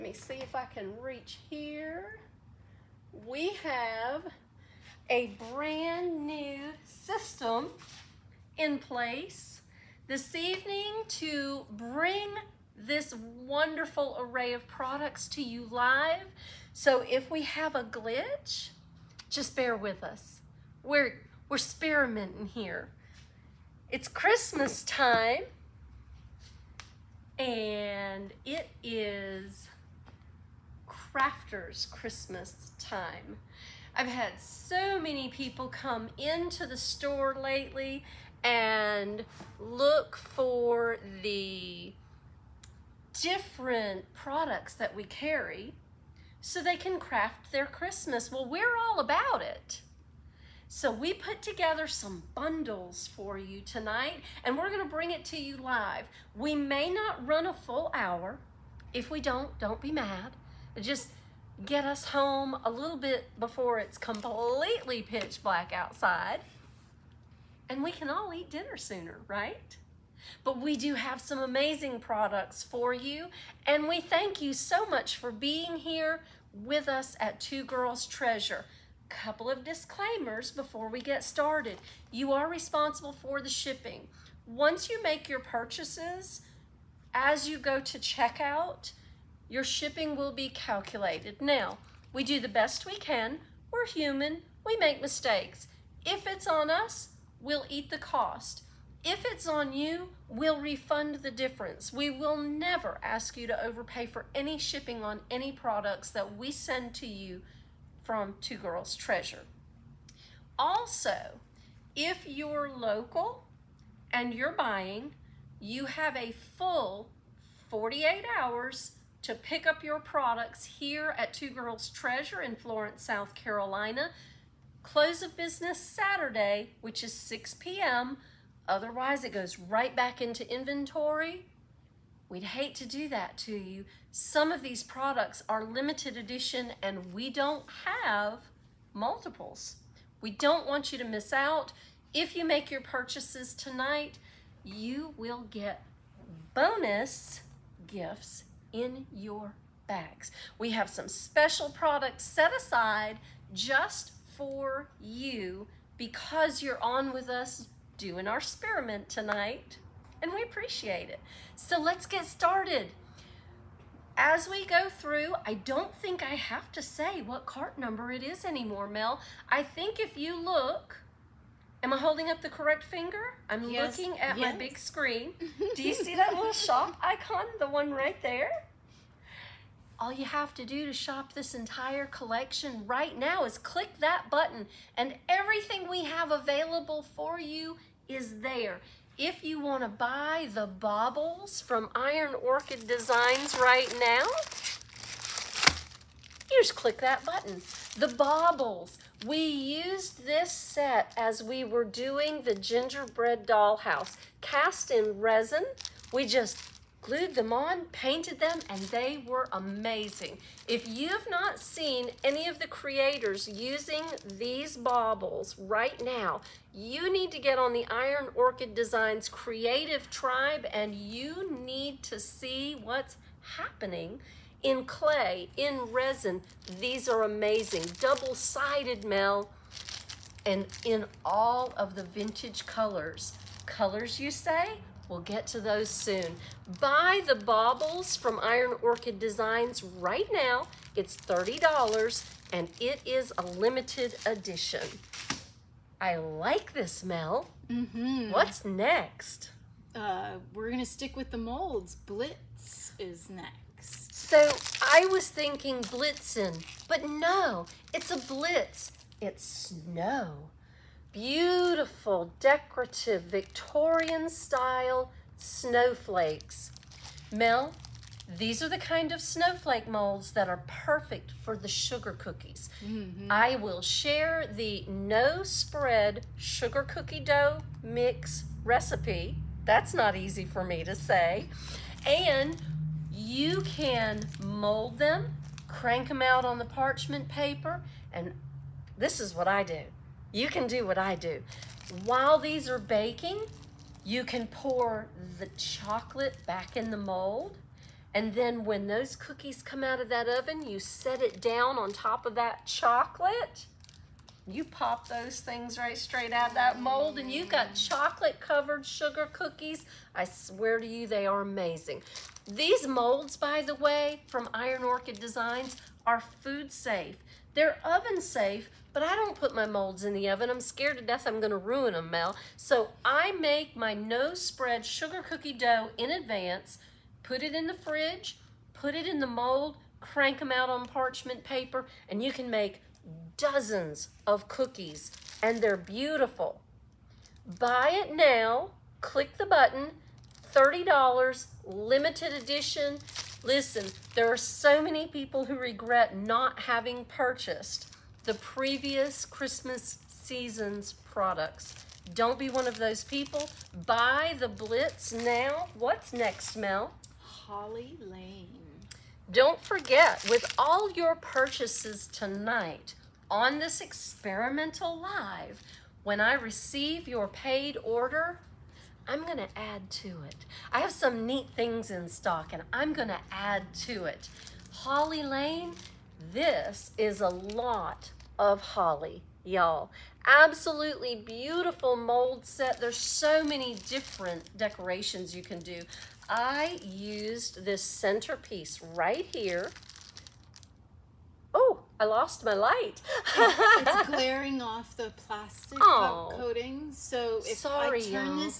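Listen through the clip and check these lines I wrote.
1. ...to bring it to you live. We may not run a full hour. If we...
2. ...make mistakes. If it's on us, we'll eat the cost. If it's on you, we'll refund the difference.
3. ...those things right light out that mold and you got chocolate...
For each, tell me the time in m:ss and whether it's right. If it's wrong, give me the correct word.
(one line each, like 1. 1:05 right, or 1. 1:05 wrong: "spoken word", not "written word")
1. 0:54 right
2. 1:34 right
3. 5:05 wrong: "straight", not "light".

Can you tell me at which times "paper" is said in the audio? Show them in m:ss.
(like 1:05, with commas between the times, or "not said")
4:47, 5:31.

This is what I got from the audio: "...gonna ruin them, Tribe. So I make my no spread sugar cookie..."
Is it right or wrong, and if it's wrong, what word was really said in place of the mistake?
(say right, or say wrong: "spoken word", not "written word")
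wrong: "Mel", not "Tribe".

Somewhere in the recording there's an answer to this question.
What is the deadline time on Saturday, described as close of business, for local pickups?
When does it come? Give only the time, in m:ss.
2:07.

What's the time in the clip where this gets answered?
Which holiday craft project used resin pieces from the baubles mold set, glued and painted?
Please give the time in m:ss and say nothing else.
3:22.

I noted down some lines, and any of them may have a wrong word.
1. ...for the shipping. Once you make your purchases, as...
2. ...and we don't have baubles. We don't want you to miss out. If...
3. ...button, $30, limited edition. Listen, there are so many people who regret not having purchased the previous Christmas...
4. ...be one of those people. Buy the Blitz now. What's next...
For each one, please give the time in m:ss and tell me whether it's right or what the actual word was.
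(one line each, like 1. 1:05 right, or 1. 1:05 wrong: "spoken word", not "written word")
1. 1:23 right
2. 2:16 wrong: "multiples", not "baubles"
3. 5:39 right
4. 5:52 right.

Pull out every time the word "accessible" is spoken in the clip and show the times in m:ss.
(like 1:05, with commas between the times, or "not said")
not said.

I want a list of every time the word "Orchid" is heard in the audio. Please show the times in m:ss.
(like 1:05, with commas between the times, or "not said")
3:12, 3:38, 3:58, 5:14.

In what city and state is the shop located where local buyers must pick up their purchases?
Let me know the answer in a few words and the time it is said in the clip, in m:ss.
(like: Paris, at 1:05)
Florence, South Carolina, at 2:02.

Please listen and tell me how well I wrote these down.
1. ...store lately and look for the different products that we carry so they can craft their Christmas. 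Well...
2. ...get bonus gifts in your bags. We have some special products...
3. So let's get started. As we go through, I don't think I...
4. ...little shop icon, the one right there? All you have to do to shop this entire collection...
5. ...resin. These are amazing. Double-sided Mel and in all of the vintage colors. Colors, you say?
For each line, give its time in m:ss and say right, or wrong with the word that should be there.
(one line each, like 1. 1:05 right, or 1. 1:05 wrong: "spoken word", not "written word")
1. 0:36 right
2. 2:25 right
3. 2:41 right
4. 2:56 right
5. 3:45 right.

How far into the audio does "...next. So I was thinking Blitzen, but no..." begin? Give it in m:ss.
4:13.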